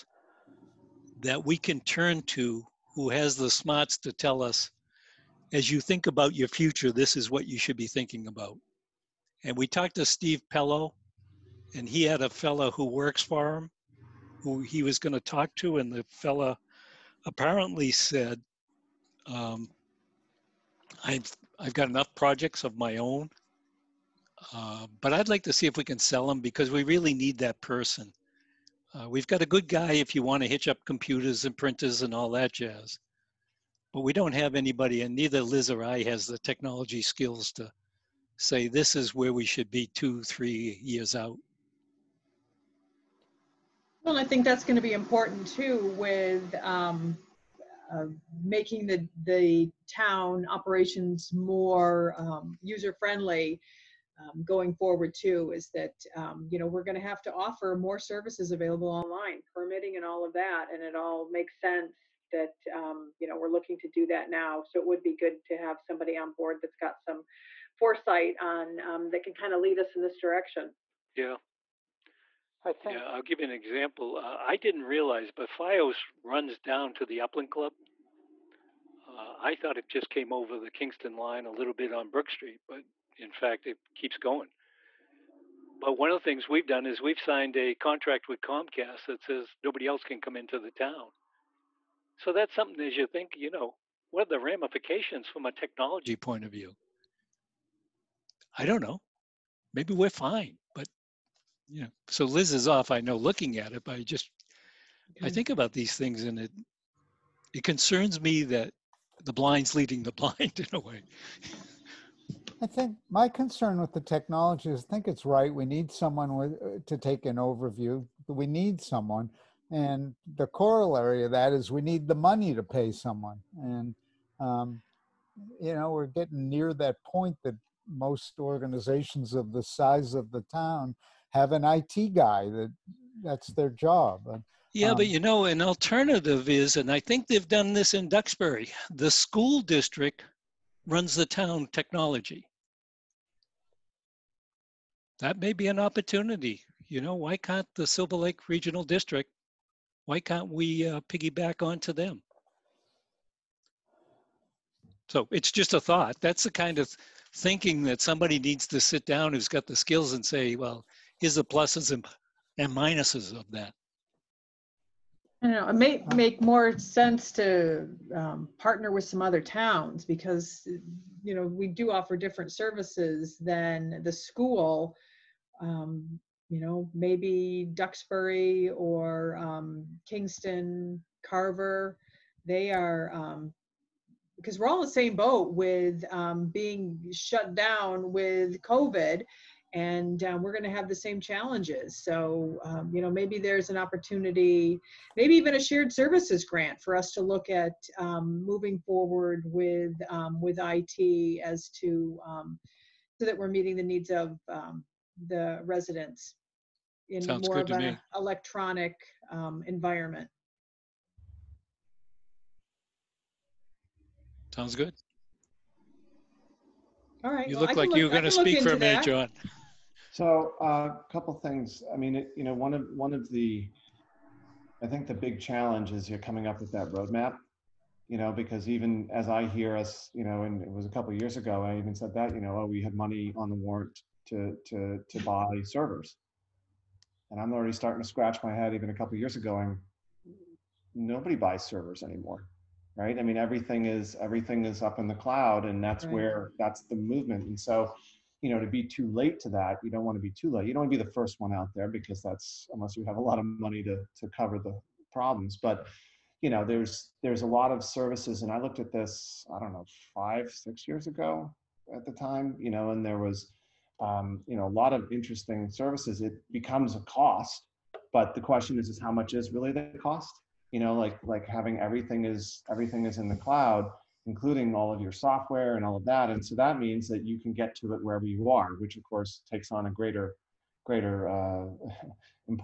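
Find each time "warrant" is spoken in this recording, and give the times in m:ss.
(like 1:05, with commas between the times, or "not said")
3:53.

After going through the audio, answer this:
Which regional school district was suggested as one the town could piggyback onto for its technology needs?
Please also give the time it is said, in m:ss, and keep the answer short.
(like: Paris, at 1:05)
Silver Lake Regional District, at 2:27.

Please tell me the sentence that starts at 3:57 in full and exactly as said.
And I'm already starting to scratch my head even a couple years ago and nobody buys servers anymore.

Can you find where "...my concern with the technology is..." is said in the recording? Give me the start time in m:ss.
1:53.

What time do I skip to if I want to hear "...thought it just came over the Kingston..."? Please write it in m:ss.
1:19.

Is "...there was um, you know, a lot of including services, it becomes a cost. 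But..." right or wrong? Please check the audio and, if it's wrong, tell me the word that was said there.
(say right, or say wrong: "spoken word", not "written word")
wrong: "interesting", not "including".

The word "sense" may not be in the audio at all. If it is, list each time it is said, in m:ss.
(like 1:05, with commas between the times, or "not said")
1:01, 2:46.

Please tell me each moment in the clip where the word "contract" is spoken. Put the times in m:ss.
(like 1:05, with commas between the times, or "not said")
1:27.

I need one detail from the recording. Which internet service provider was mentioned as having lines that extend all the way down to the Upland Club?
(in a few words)
FiOS.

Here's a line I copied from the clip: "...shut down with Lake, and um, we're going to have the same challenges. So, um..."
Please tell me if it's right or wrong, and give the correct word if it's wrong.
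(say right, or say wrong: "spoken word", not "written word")
wrong: "COVID", not "Lake".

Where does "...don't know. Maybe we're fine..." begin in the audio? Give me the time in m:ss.
1:38.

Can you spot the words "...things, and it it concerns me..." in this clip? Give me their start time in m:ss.
1:45.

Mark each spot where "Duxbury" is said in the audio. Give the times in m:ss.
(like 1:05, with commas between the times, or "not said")
2:18, 2:57.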